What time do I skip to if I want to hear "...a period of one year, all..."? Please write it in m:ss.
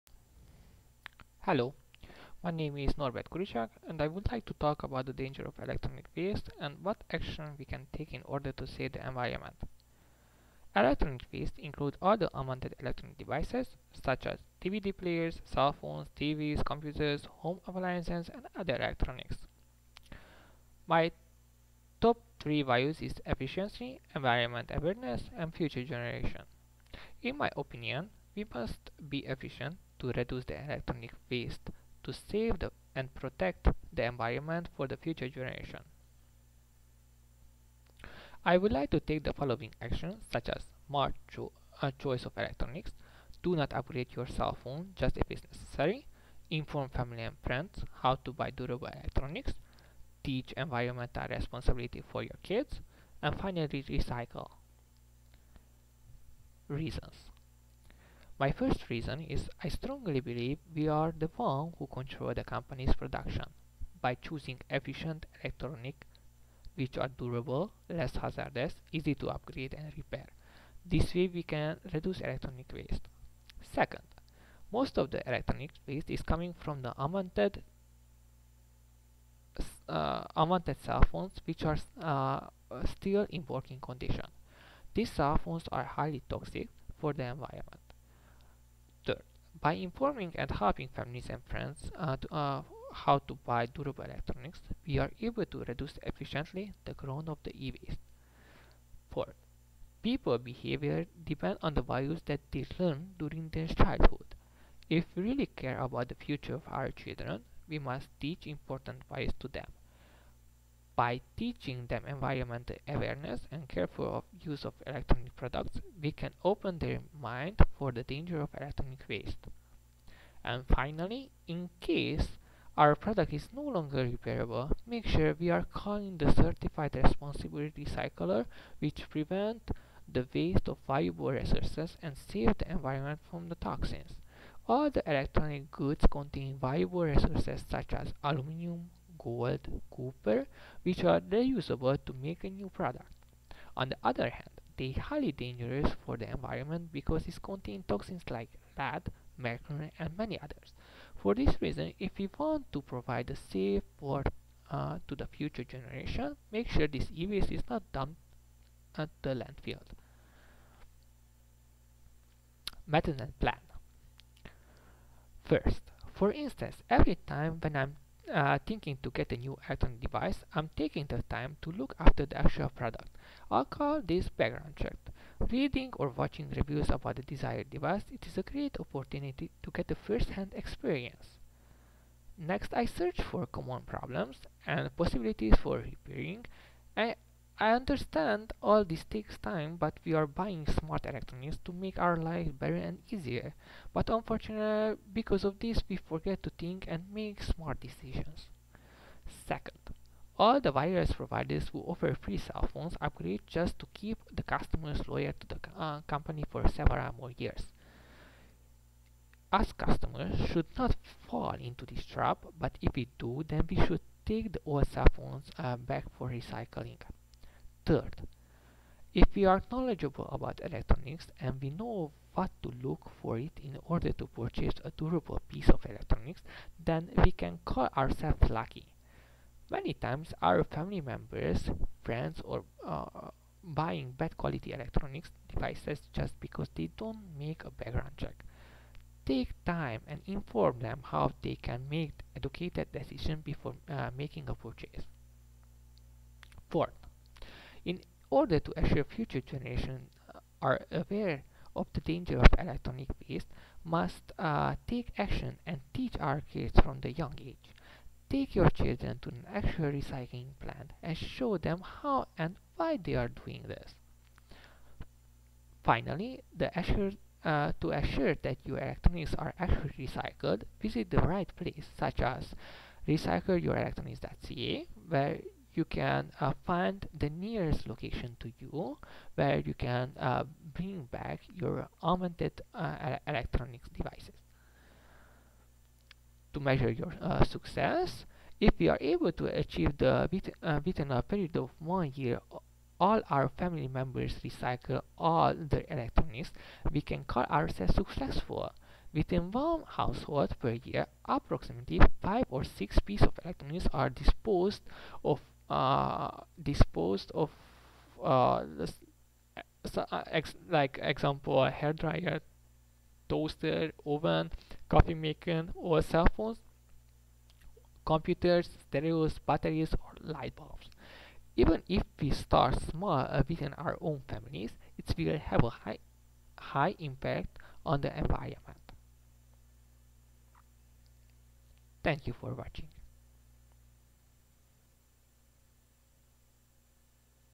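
4:51.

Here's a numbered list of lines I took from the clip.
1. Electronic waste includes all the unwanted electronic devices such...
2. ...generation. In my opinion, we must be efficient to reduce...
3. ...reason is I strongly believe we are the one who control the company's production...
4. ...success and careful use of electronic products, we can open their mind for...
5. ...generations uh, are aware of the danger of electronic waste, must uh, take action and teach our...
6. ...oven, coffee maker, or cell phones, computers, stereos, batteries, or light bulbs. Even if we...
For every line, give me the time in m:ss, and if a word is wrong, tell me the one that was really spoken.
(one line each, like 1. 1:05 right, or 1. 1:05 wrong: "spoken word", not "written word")
1. 0:10 right
2. 0:25 right
3. 0:58 right
4. 1:52 wrong: "awareness", not "success"
5. 4:09 right
6. 5:14 right.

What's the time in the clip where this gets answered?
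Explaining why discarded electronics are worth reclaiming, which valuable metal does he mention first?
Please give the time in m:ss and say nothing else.
2:18.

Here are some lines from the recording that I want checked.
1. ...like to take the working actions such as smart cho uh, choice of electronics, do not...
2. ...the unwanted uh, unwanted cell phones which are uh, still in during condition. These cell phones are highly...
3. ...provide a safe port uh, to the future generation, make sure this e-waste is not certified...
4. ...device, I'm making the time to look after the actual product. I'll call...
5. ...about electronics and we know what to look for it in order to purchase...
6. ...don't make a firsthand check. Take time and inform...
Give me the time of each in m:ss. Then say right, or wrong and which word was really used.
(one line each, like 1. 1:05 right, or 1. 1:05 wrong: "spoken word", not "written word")
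1. 0:38 wrong: "following", not "working"
2. 1:16 wrong: "working", not "during"
3. 2:32 wrong: "dumped", not "certified"
4. 2:50 wrong: "taking", not "making"
5. 3:40 right
6. 3:56 wrong: "background", not "firsthand".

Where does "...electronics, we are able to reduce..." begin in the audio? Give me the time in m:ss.
1:34.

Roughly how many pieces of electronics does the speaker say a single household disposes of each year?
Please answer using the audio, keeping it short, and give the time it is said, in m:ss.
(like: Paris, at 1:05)
5 or 6, at 5:02.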